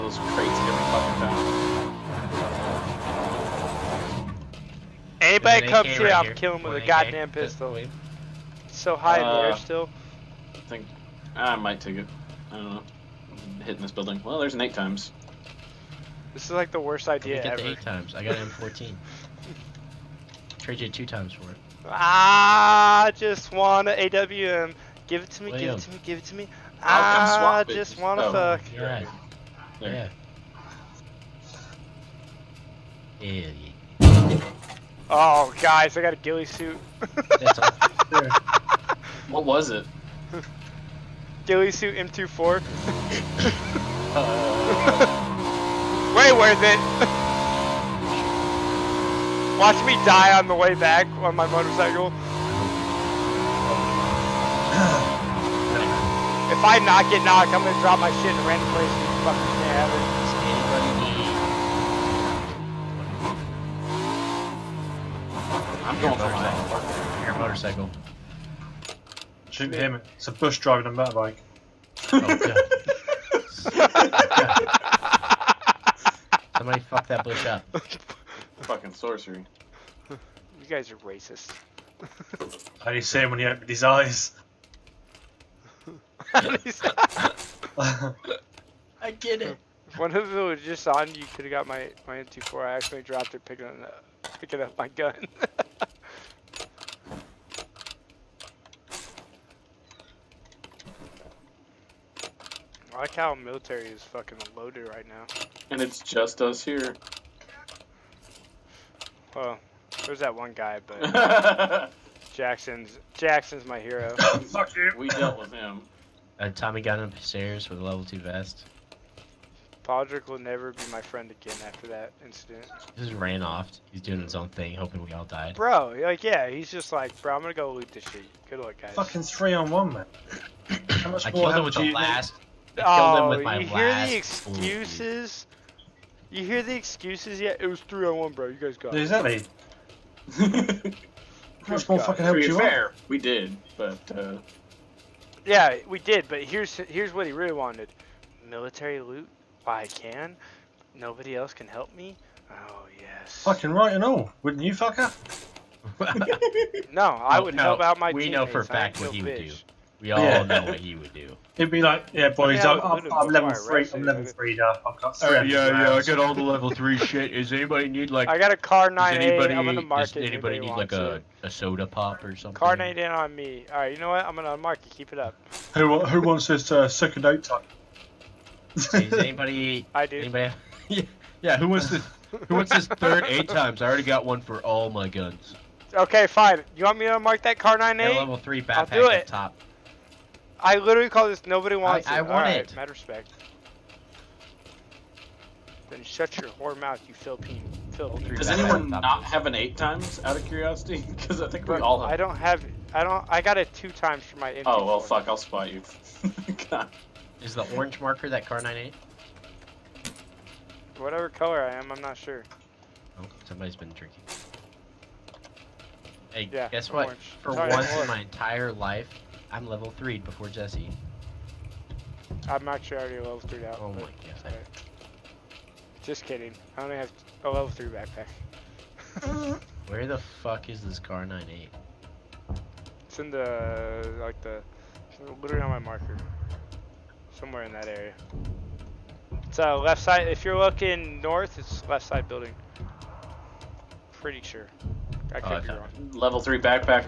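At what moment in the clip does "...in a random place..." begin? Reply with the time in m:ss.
0:58.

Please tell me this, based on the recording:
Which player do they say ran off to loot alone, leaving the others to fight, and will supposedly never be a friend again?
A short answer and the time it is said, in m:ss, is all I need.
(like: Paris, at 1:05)
Podrick, at 1:59.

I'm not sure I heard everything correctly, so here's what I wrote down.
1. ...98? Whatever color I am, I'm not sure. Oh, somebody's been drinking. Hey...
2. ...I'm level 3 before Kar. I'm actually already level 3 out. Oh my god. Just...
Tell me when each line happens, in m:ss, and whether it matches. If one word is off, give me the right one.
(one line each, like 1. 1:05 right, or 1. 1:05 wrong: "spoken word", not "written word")
1. 3:28 right
2. 3:39 wrong: "Jesse", not "Kar".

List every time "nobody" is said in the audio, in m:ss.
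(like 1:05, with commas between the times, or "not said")
2:30, 3:11.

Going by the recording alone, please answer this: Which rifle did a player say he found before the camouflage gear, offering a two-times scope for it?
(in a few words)
M14.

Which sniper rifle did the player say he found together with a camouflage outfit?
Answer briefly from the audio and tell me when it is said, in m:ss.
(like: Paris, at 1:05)
M24, at 0:41.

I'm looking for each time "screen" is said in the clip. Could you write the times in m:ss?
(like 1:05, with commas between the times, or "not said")
not said.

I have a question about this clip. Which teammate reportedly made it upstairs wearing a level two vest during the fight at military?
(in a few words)
Tommy.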